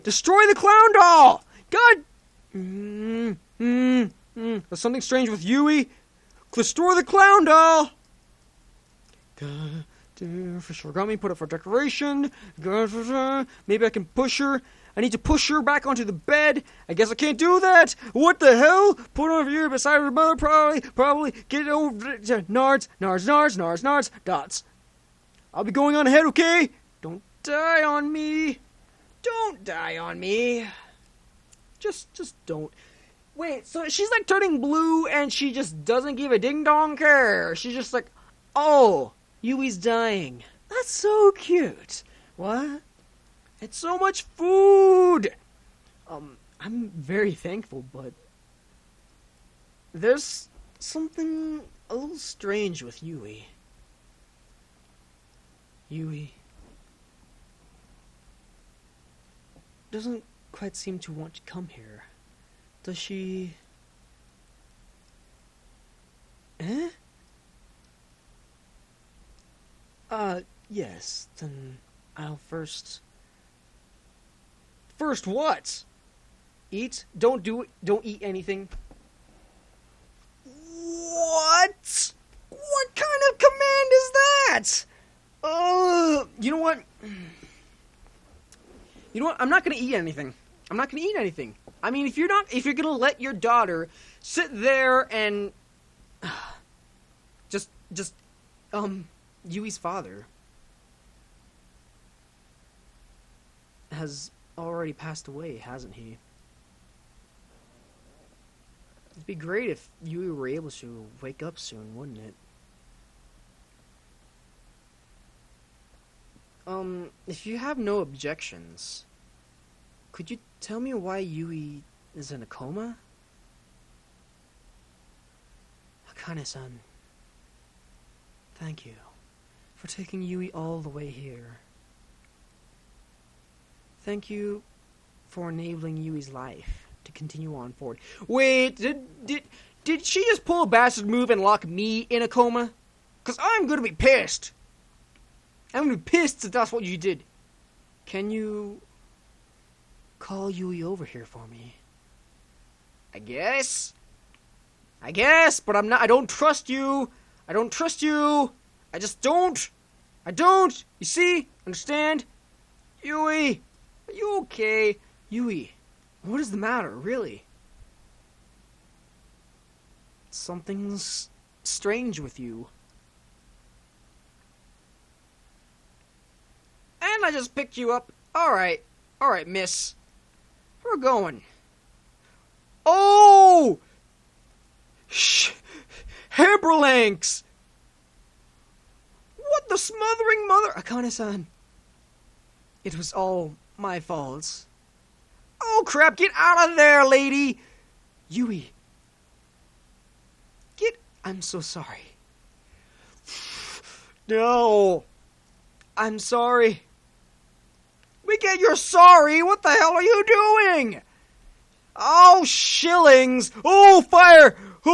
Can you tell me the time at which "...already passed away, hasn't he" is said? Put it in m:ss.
1:44.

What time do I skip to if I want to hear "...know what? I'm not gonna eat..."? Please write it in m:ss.
1:29.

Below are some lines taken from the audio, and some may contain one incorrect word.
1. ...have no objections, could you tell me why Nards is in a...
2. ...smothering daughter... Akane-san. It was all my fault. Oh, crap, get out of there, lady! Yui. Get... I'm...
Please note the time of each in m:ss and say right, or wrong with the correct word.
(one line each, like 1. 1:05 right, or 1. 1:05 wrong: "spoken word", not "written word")
1. 1:57 wrong: "Yui", not "Nards"
2. 3:09 wrong: "mother", not "daughter".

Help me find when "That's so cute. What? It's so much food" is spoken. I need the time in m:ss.
0:40.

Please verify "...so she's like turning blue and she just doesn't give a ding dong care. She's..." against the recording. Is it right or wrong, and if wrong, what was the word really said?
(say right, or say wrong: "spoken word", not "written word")
right.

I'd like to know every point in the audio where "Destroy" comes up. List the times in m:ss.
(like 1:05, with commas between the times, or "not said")
0:00, 0:06.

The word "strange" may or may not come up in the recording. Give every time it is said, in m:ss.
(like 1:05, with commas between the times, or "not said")
0:05, 0:52, 2:51.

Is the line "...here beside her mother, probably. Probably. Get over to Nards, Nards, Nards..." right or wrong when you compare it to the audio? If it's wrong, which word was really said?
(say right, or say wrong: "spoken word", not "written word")
right.